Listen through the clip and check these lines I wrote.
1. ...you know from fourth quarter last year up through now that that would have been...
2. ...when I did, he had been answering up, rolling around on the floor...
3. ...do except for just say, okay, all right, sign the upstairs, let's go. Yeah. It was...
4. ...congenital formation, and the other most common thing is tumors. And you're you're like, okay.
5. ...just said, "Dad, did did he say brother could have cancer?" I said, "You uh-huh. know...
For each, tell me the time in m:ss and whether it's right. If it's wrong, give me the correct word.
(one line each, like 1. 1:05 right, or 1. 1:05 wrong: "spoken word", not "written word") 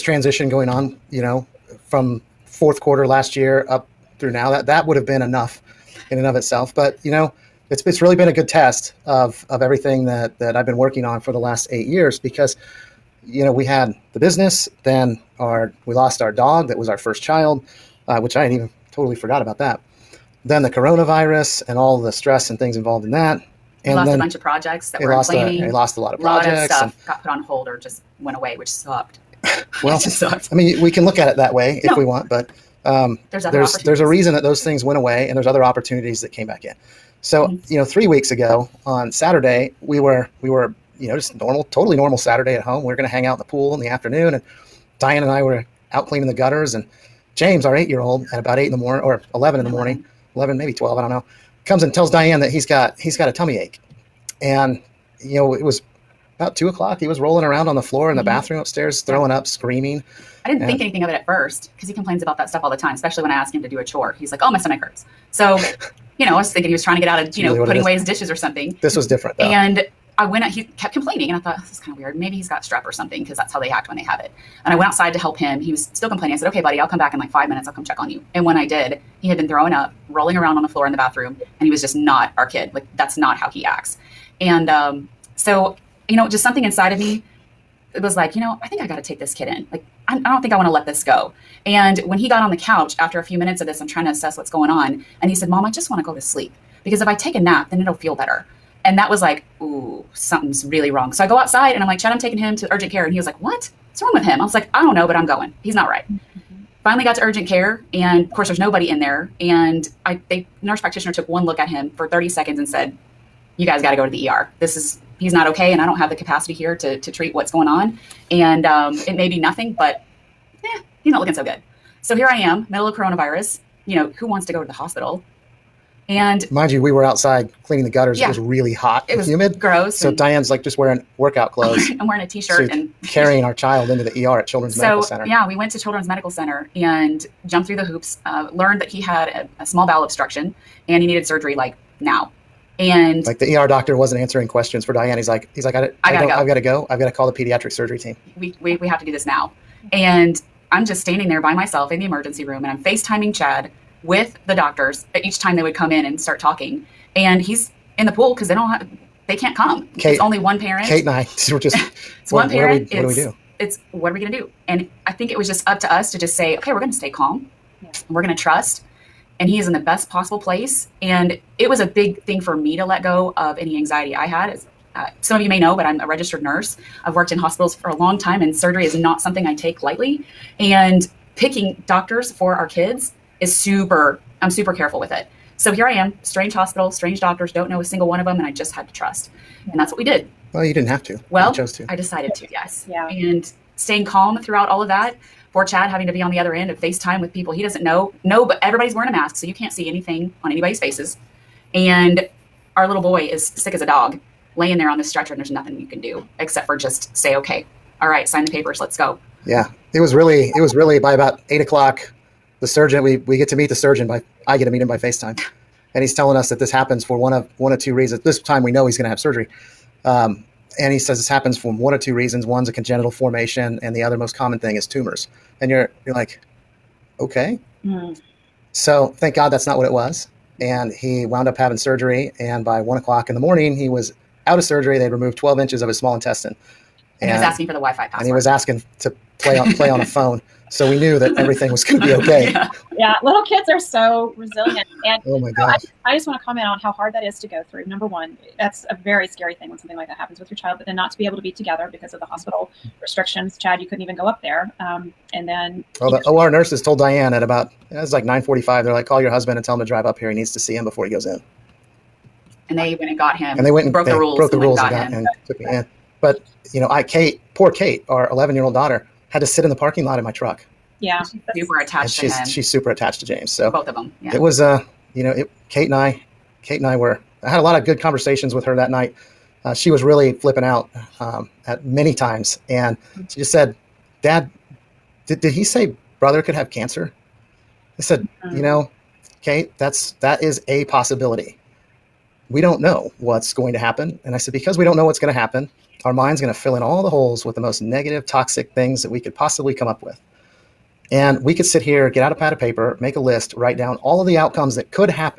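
1. 0:01 right
2. 1:18 wrong: "throwing", not "answering"
3. 3:25 wrong: "papers", not "upstairs"
4. 3:42 right
5. 4:43 right.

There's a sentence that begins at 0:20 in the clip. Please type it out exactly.
Then the coronavirus and all the stress and things involved in that.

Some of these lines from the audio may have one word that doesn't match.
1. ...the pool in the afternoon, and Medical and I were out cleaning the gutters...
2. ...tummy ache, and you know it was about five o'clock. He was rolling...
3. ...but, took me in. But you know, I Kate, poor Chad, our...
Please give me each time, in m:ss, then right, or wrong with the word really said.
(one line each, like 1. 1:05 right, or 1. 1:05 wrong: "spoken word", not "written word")
1. 0:43 wrong: "Diane", not "Medical"
2. 0:53 wrong: "two", not "five"
3. 4:25 wrong: "Kate", not "Chad".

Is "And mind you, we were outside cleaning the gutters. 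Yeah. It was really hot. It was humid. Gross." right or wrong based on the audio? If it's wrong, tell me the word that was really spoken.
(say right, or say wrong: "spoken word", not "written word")
right.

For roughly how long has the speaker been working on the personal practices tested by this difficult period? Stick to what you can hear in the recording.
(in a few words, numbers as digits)
8 years.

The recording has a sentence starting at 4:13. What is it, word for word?
Chad, you couldn't even go up there.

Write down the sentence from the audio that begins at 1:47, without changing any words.
And of course, there's nobody in there.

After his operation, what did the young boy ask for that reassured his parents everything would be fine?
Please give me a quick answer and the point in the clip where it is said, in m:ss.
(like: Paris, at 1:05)
the Wi-Fi password, at 3:57.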